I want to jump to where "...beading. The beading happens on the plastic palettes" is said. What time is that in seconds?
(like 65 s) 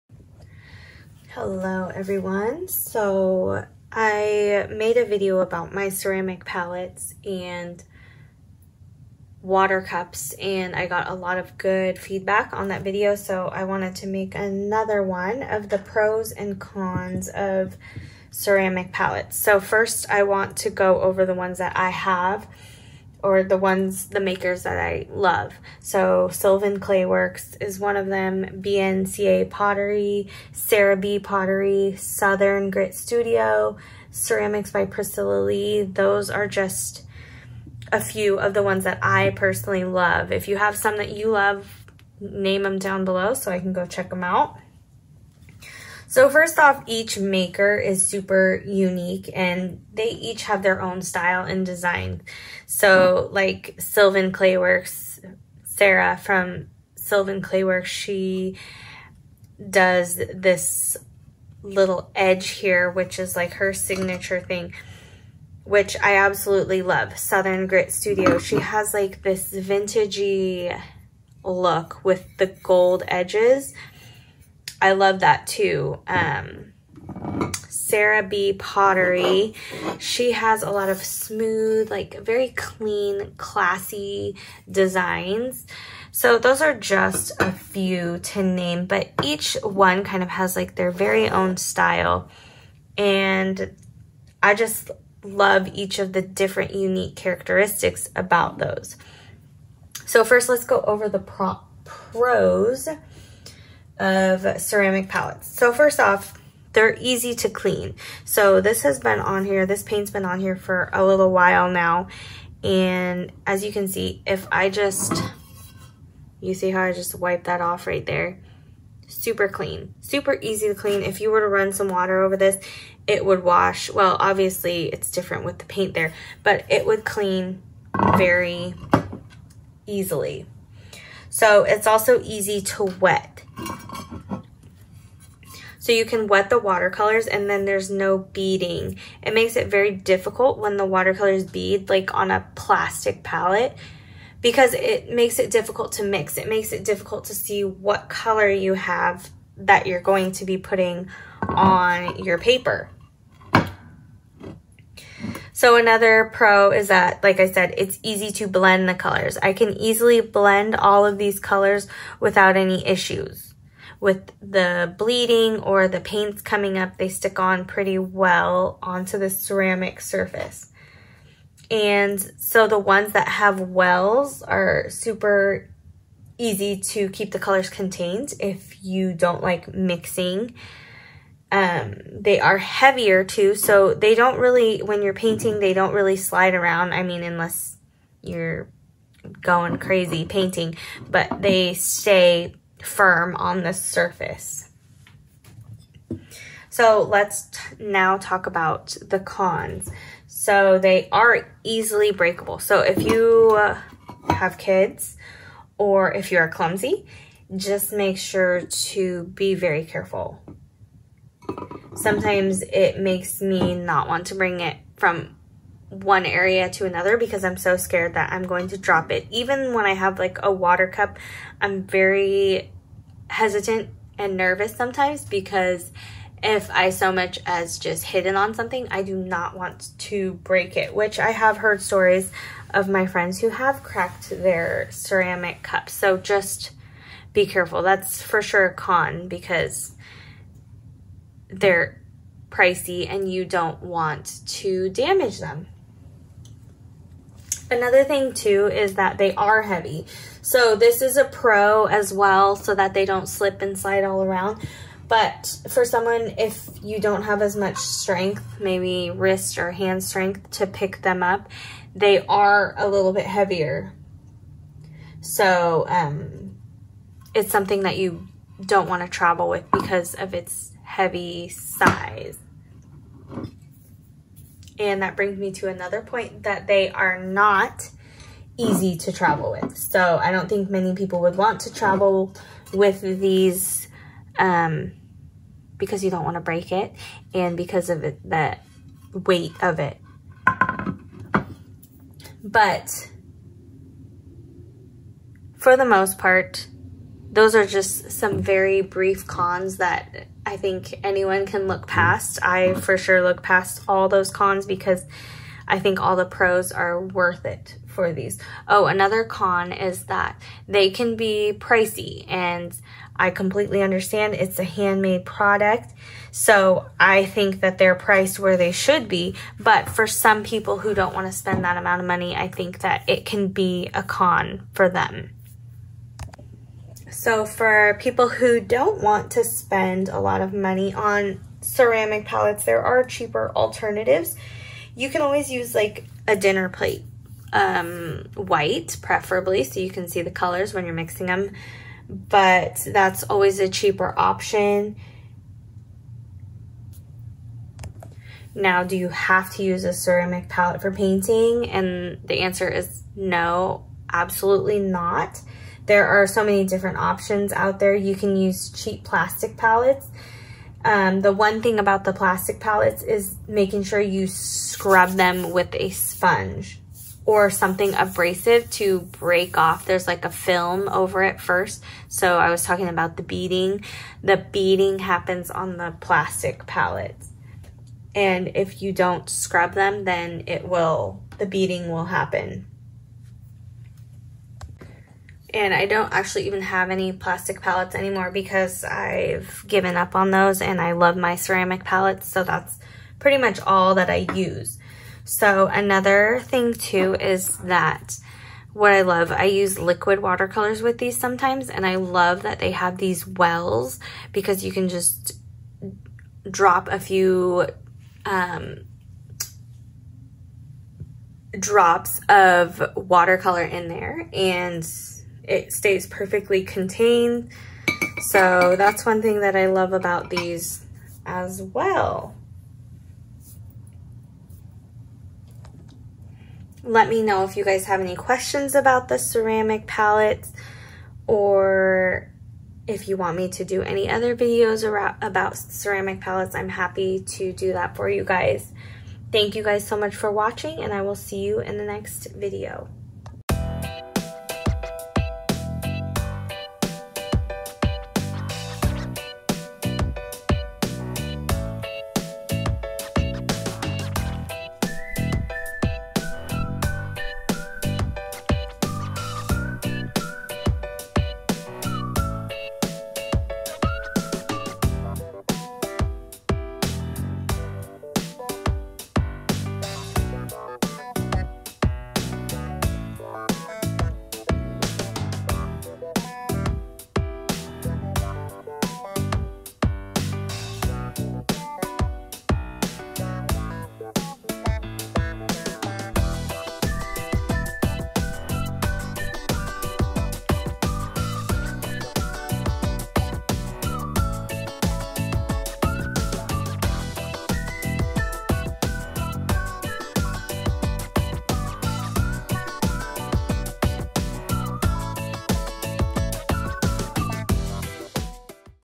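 373 s.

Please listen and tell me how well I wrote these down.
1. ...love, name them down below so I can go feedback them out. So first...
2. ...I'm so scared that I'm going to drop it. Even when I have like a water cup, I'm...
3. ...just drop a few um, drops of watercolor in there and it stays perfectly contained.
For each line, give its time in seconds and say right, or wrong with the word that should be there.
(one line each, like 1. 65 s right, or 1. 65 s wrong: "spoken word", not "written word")
1. 41 s wrong: "check", not "feedback"
2. 217 s right
3. 404 s right.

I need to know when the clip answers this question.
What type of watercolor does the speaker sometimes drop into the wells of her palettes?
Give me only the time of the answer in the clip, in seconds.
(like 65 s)
399 s.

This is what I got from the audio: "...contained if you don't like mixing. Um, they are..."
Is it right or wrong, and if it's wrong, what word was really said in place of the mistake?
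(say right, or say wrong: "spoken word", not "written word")
right.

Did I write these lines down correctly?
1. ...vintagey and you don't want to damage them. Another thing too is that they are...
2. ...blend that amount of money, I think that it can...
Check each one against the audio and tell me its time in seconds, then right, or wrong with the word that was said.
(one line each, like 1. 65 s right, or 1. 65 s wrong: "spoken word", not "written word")
1. 242 s wrong: "pricey", not "vintagey"
2. 321 s wrong: "spend", not "blend".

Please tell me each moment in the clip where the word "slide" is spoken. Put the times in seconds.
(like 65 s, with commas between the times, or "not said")
186 s, 253 s.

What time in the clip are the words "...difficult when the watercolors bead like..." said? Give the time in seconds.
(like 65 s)
139 s.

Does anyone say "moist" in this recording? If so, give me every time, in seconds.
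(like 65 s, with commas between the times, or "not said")
not said.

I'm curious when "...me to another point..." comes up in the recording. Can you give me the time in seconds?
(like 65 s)
275 s.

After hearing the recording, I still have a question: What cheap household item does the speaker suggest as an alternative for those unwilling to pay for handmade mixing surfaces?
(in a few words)
A dinner plate.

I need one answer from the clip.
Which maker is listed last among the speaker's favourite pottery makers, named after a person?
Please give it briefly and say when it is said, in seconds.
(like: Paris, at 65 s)
Ceramics by Priscilla Lee, at 34 s.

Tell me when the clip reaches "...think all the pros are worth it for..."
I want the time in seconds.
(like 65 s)
305 s.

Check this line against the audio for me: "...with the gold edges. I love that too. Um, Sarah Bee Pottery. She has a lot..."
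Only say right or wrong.
right.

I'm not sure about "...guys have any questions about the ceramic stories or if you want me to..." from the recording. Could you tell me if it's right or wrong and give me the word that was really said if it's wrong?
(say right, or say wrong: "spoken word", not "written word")
wrong: "palettes", not "stories".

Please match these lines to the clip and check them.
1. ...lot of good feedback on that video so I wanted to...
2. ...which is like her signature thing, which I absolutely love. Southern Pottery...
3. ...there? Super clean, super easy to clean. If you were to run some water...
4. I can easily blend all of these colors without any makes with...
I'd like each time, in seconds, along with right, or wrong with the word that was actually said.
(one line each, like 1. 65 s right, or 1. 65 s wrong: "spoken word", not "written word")
1. 11 s right
2. 62 s wrong: "Grit", not "Pottery"
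3. 118 s right
4. 159 s wrong: "issues", not "makes".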